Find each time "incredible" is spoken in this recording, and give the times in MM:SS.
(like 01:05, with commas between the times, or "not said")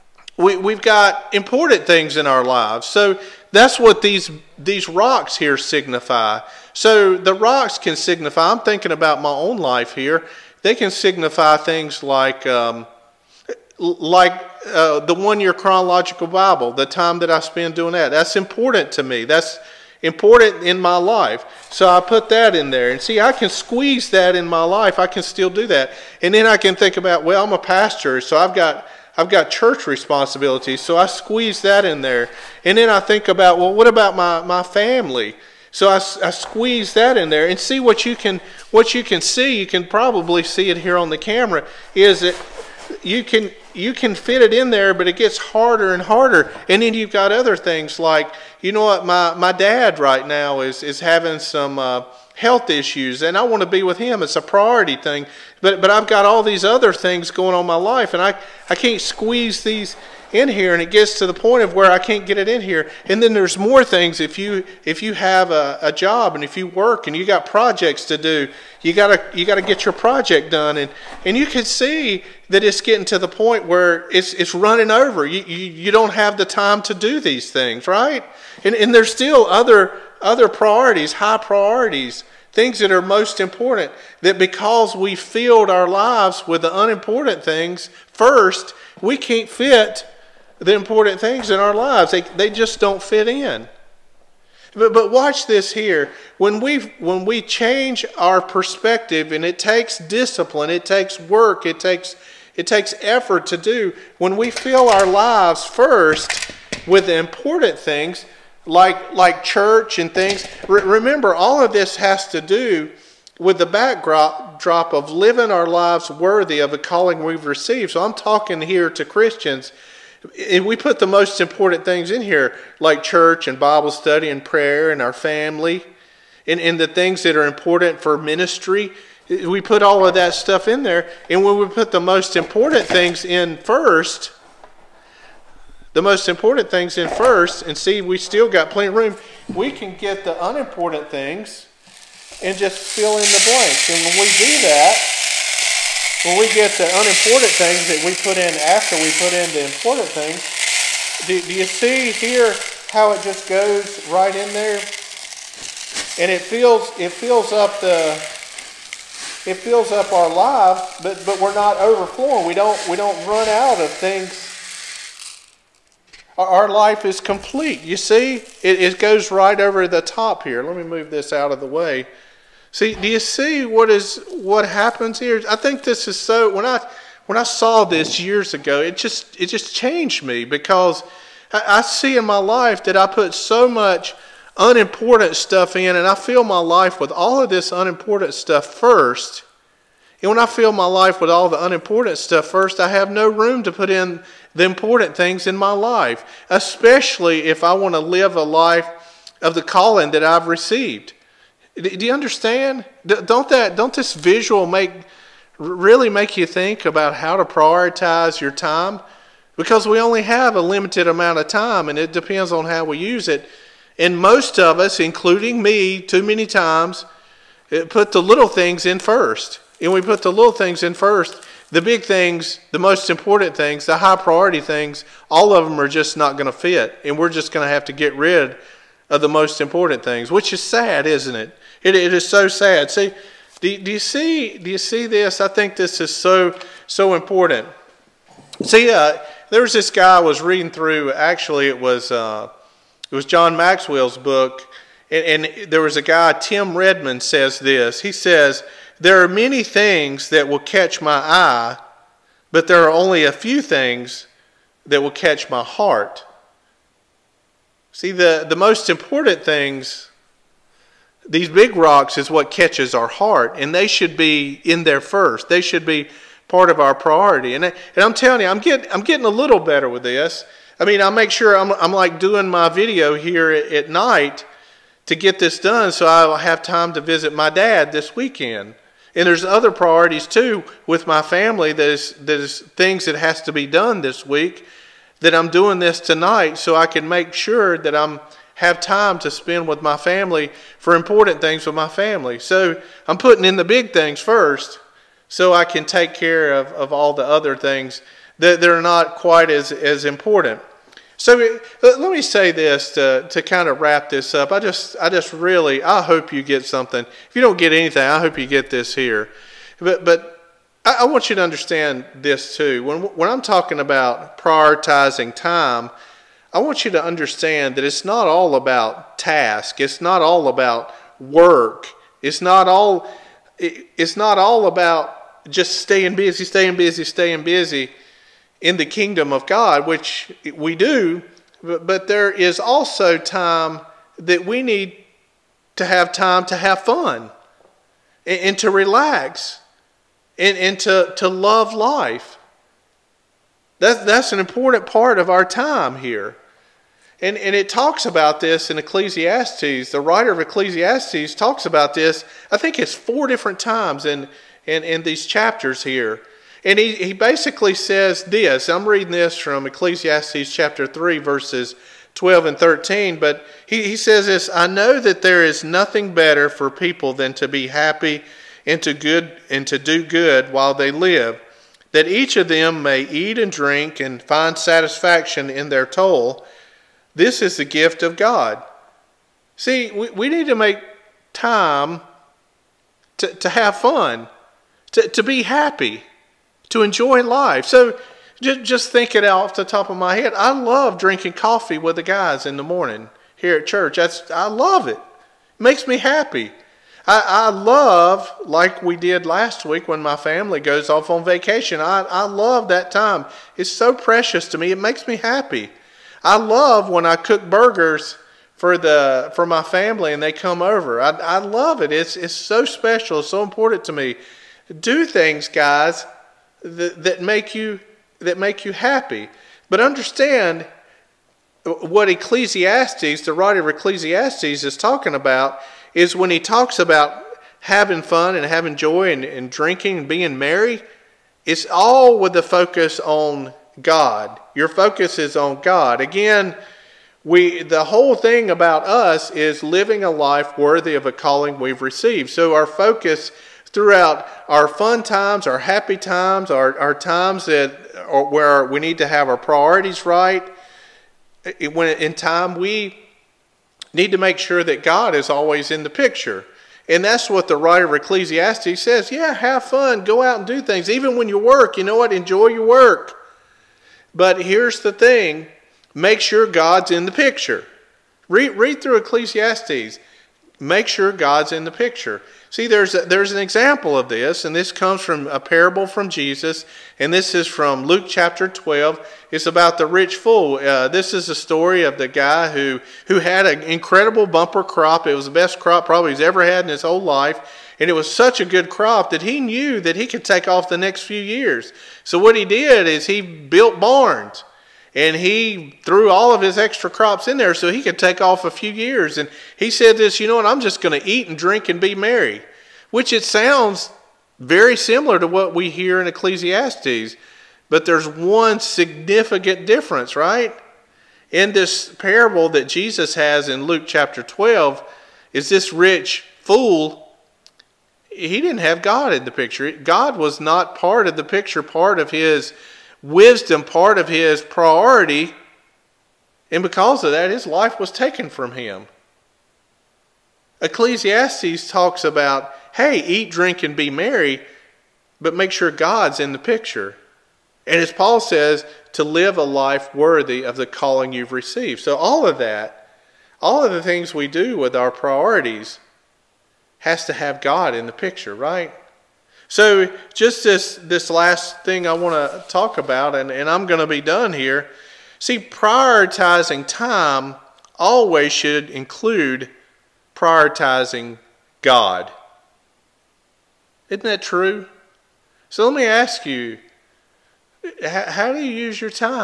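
08:03.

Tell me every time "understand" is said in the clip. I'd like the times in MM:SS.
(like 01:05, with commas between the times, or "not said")
03:22, 05:11, 05:17, 06:59.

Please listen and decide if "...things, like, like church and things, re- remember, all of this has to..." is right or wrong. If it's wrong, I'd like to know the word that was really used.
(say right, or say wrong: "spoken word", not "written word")
right.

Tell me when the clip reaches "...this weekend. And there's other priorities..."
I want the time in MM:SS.
04:37.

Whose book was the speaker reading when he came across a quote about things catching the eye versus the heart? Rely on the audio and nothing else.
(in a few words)
John Maxwell.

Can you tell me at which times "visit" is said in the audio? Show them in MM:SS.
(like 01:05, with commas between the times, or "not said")
04:37.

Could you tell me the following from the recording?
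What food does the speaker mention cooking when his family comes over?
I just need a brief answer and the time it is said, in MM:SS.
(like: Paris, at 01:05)
Burgers, at 06:47.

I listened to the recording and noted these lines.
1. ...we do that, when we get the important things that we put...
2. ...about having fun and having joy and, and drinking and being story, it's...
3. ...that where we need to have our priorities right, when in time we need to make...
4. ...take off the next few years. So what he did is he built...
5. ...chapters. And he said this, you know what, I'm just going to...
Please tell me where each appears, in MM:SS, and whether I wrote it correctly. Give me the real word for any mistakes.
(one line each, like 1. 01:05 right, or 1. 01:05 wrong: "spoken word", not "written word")
1. 02:24 wrong: "unimportant", not "important"
2. 07:06 wrong: "merry", not "story"
3. 07:27 right
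4. 08:10 right
5. 08:18 wrong: "years", not "chapters".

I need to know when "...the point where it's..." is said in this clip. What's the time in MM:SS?
01:13.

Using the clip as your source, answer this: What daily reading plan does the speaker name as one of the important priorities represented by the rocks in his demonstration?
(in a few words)
One year chronological Bible.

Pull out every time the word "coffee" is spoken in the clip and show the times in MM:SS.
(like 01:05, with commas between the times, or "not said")
06:31.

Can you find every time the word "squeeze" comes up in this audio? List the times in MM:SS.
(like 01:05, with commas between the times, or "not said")
00:23, 00:31, 00:36, 00:59.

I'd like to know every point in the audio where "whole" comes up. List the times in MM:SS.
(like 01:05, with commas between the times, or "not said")
07:17, 08:06.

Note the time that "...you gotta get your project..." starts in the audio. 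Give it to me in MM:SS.
01:09.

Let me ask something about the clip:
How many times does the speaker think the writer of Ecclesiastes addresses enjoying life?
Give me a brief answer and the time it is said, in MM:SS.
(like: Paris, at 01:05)
4, at 05:52.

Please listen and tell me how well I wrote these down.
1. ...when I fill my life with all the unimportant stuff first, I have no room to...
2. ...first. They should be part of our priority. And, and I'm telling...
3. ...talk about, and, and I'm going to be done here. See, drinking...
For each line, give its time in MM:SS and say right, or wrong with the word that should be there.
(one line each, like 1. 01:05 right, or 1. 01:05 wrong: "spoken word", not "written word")
1. 03:10 right
2. 04:25 right
3. 09:12 wrong: "prioritizing", not "drinking".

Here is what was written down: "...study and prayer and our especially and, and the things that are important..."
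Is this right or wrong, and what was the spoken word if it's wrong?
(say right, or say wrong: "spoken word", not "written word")
wrong: "family", not "especially".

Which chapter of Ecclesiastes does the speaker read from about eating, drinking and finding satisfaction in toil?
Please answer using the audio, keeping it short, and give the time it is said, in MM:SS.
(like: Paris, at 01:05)
Chapter 3, at 06:00.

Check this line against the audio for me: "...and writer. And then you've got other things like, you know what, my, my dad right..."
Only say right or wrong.
wrong.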